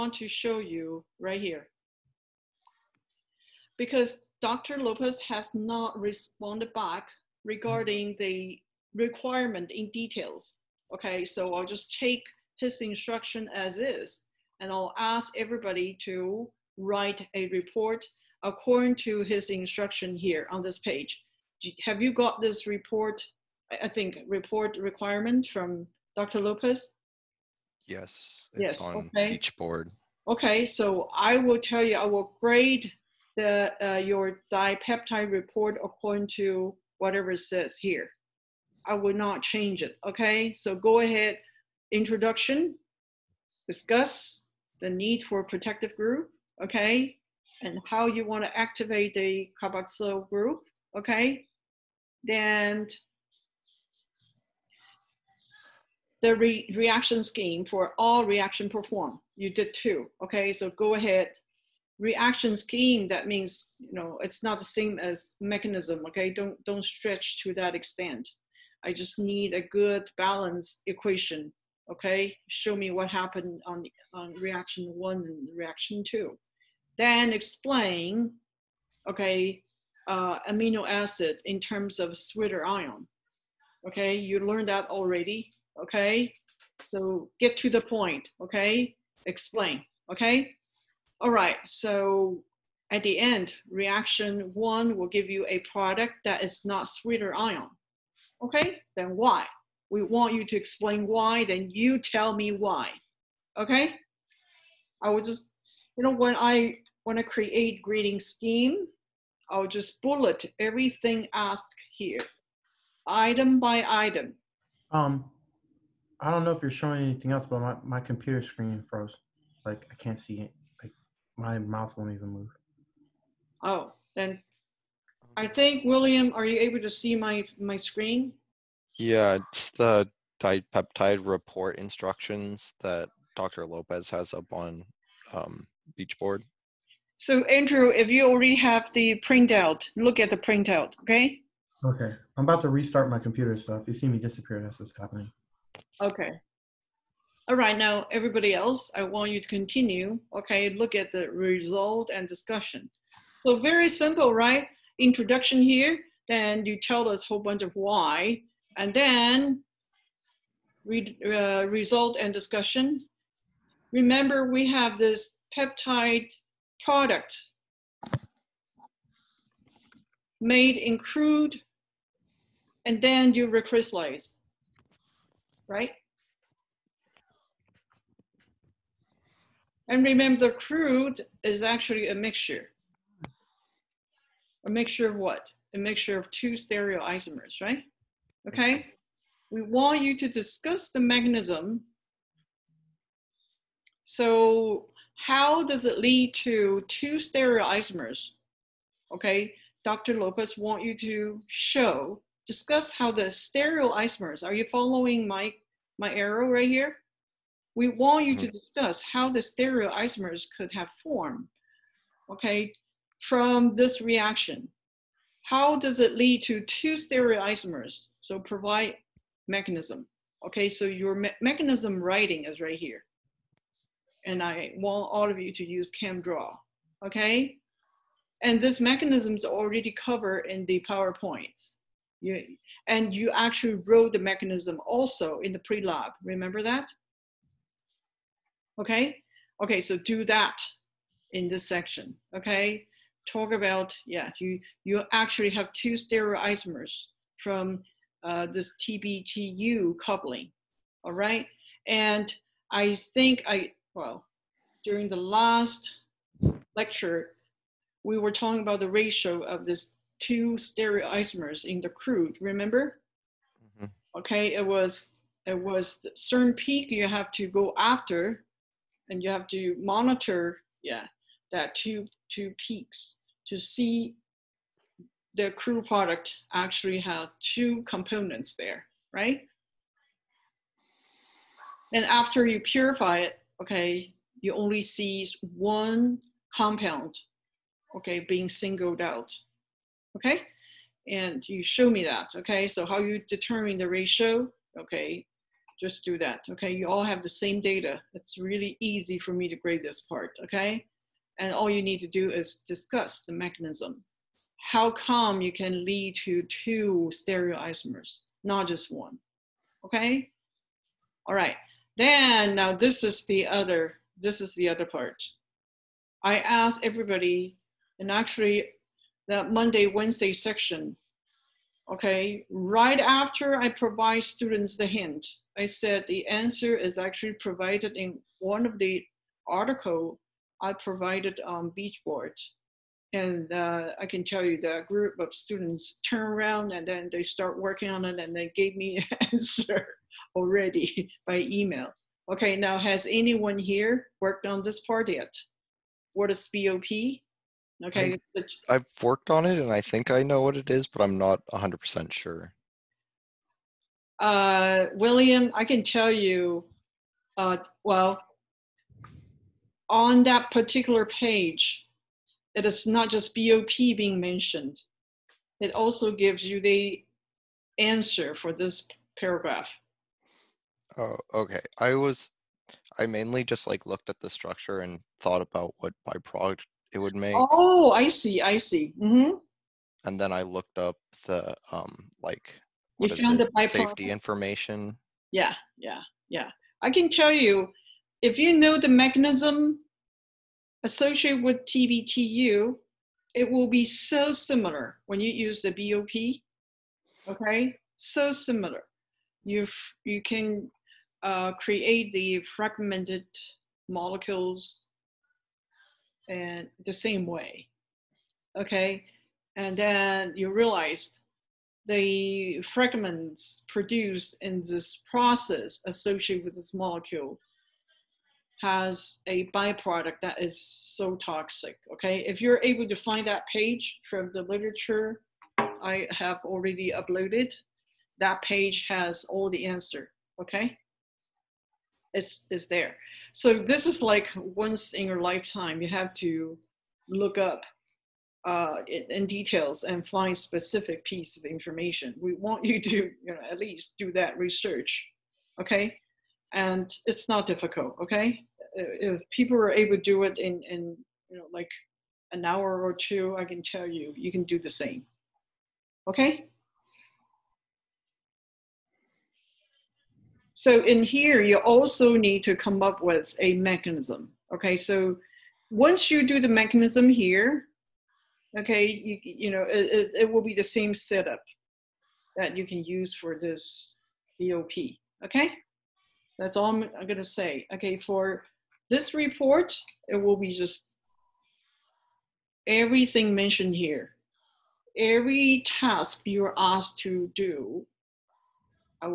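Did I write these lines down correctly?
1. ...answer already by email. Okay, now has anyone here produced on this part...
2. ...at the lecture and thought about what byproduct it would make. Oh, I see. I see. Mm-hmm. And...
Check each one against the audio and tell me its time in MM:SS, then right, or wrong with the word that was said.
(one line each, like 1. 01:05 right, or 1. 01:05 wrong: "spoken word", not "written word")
1. 05:39 wrong: "worked", not "produced"
2. 06:14 wrong: "structure", not "lecture".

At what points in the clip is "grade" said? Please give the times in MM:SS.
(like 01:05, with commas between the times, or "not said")
00:32, 04:59.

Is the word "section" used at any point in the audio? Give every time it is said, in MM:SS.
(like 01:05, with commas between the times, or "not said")
04:01, 05:20.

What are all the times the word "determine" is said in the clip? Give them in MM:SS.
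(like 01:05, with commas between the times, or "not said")
04:53.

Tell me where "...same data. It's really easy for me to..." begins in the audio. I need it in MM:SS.
04:57.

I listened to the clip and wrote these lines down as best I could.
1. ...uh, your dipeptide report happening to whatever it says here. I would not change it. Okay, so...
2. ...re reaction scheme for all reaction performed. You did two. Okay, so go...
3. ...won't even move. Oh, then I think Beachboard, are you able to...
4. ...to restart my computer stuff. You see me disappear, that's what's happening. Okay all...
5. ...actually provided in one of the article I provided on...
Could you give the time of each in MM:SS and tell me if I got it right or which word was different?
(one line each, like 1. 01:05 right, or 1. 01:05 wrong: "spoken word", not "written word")
1. 00:33 wrong: "according", not "happening"
2. 00:56 right
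3. 02:01 wrong: "William", not "Beachboard"
4. 02:22 right
5. 05:26 right.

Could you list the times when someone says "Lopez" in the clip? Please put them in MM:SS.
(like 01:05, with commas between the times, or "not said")
00:04, 00:26, 02:13, 03:20.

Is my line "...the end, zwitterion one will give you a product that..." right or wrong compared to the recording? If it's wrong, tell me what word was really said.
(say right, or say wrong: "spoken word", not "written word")
wrong: "reaction", not "zwitterion".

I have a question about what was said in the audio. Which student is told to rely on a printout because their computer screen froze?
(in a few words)
Andrew.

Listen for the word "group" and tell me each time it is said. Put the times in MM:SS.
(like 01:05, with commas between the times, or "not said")
00:45, 00:50, 05:34.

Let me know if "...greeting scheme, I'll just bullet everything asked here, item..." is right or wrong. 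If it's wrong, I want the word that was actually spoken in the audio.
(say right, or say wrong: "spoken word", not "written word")
right.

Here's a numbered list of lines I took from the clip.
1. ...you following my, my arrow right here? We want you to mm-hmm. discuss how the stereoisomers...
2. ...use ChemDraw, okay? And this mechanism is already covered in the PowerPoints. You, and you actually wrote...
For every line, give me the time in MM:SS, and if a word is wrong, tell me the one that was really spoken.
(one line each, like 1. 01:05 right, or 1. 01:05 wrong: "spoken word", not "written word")
1. 03:24 right
2. 03:45 right.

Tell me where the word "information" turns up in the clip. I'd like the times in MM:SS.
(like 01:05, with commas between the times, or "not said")
06:24, 07:21.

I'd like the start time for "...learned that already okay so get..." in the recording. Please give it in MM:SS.
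01:24.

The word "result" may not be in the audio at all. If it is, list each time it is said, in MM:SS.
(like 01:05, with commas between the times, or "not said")
02:31, 02:41.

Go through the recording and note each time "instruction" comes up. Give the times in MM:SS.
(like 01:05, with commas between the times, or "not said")
00:12, 00:19, 02:11.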